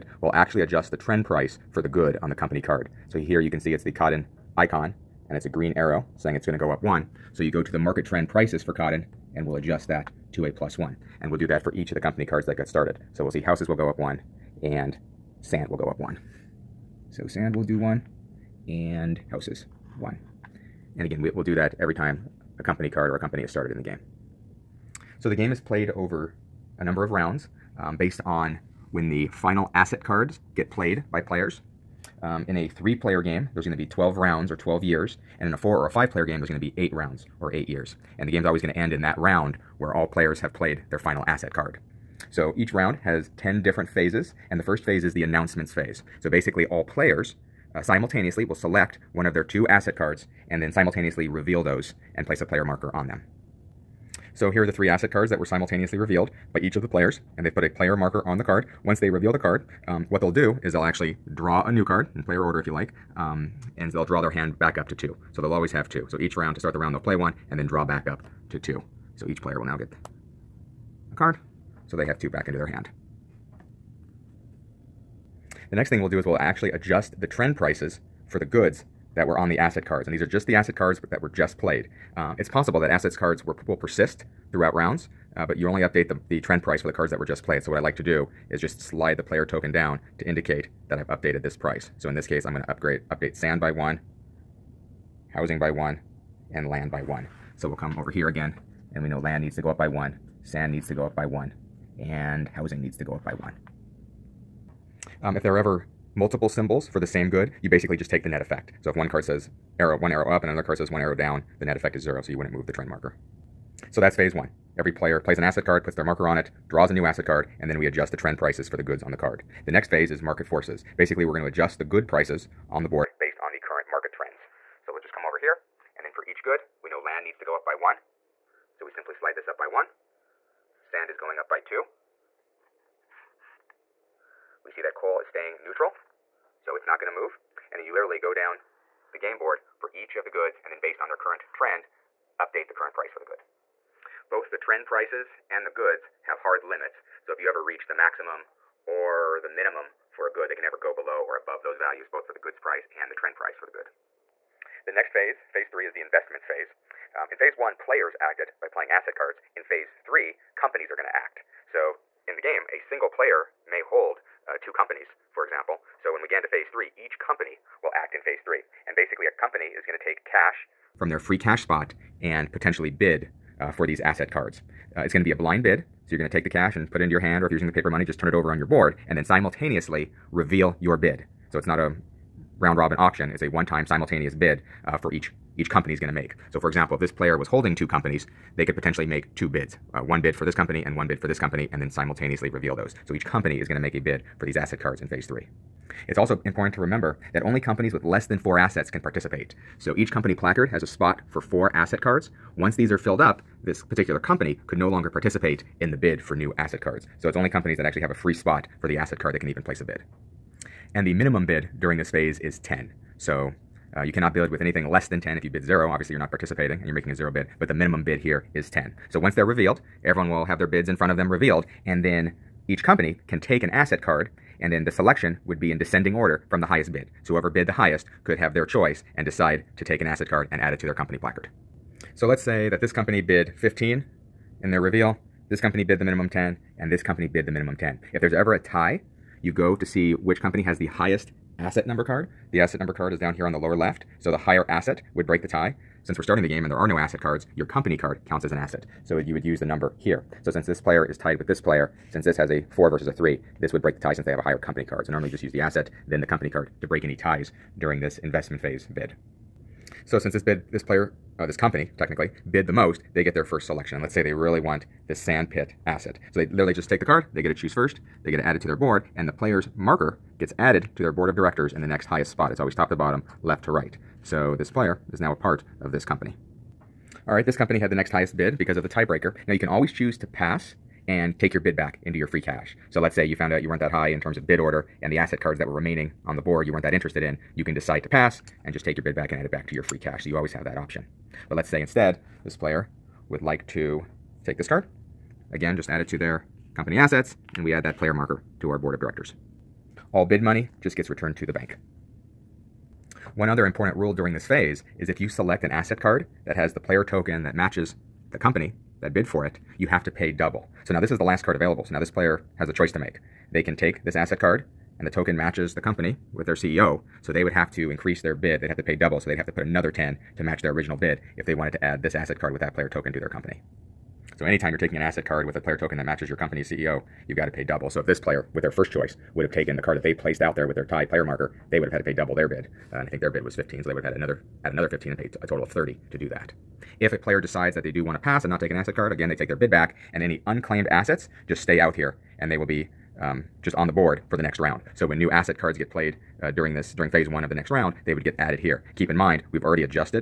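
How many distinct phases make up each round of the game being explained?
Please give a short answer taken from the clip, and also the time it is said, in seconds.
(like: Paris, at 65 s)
10, at 43 s.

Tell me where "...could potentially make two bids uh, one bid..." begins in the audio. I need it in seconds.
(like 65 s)
188 s.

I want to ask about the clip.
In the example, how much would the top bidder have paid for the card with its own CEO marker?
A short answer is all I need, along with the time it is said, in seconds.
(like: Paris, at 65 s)
30, at 335 s.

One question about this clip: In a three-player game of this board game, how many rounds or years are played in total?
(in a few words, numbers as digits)
12.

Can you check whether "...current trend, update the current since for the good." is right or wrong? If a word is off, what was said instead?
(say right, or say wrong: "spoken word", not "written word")
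wrong: "price", not "since".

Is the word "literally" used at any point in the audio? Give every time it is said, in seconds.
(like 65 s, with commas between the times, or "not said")
137 s, 266 s.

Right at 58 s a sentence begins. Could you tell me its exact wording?
Once they reveal the card, um, what they'll do is they'll actually draw a new card in player order if you like.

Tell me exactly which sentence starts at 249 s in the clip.
So you would use the number here.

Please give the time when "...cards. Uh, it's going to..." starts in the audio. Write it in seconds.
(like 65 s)
174 s.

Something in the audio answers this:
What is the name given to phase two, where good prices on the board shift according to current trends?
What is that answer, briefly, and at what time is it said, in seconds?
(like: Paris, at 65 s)
Market forces, at 120 s.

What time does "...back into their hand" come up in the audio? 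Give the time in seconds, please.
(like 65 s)
72 s.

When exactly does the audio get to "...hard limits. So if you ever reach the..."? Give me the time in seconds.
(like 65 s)
146 s.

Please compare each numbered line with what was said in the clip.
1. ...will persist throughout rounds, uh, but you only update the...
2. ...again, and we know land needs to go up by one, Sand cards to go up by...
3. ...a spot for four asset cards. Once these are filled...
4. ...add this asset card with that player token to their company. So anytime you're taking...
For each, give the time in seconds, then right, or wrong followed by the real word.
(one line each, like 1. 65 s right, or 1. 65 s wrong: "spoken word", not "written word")
1. 83 s right
2. 98 s wrong: "needs", not "cards"
3. 200 s right
4. 321 s right.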